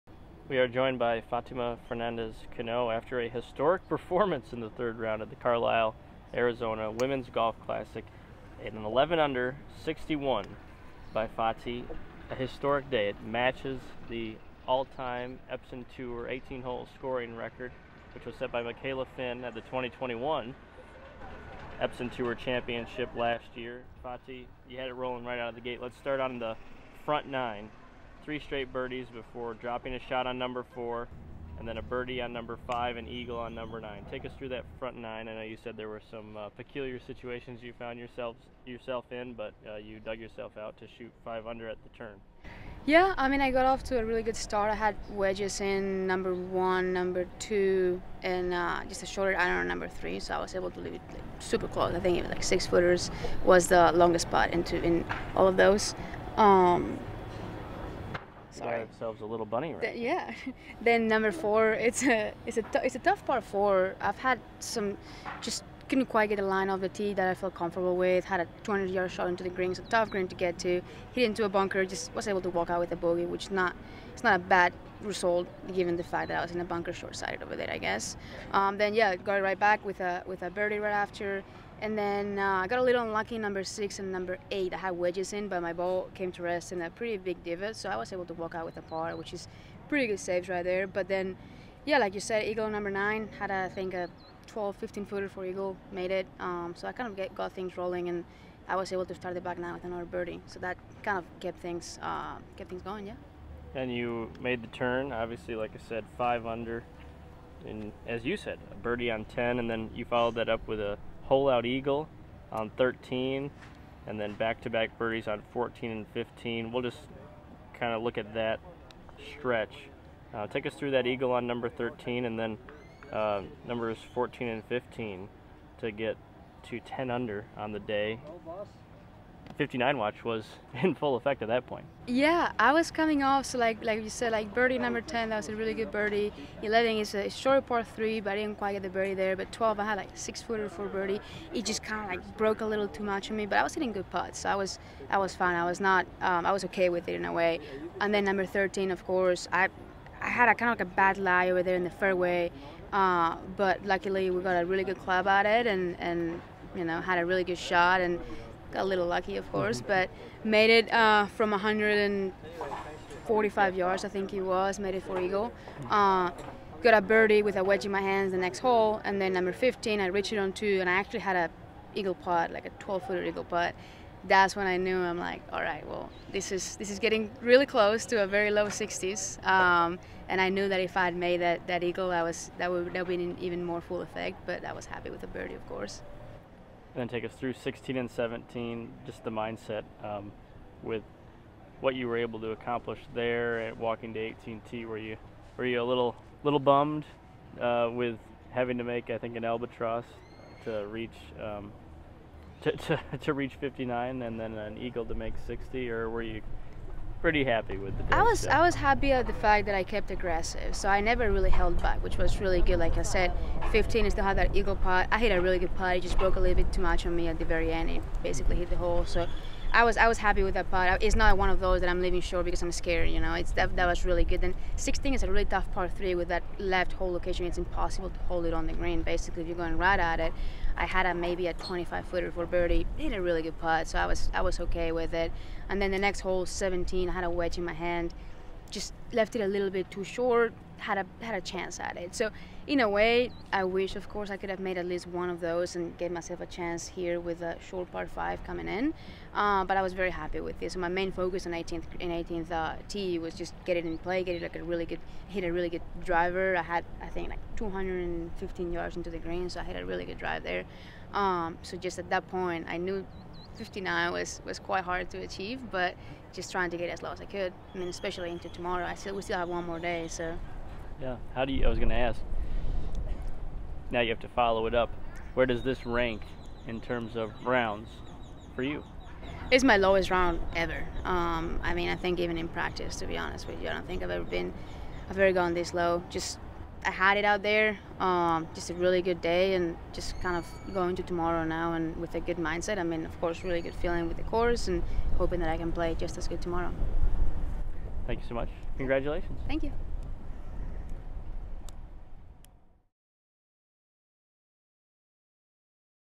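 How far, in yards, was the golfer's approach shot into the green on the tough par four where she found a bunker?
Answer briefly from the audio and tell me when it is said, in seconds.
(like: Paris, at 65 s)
200, at 68 s.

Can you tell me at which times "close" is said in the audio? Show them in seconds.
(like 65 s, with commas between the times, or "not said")
51 s, 177 s.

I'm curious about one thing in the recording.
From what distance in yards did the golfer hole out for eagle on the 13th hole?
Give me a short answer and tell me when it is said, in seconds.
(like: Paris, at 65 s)
145, at 161 s.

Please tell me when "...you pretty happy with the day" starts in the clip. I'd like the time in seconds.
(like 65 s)
206 s.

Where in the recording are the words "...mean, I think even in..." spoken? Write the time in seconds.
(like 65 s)
281 s.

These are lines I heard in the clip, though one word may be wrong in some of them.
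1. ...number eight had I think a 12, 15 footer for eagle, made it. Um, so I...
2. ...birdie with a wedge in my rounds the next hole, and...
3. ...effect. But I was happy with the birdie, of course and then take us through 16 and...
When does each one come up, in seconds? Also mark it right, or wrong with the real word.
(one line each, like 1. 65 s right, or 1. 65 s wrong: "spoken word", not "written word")
1. 92 s wrong: "nine", not "eight"
2. 167 s wrong: "hands", not "rounds"
3. 184 s right.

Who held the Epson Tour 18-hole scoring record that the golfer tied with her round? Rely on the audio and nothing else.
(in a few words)
Michaela Finn.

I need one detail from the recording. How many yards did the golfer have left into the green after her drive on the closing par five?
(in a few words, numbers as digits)
215.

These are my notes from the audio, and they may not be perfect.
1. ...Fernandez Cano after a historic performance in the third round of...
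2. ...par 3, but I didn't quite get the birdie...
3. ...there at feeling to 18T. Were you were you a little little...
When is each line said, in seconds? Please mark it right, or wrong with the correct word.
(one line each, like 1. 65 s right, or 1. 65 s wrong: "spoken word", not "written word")
1. 1 s right
2. 137 s right
3. 193 s wrong: "walking", not "feeling".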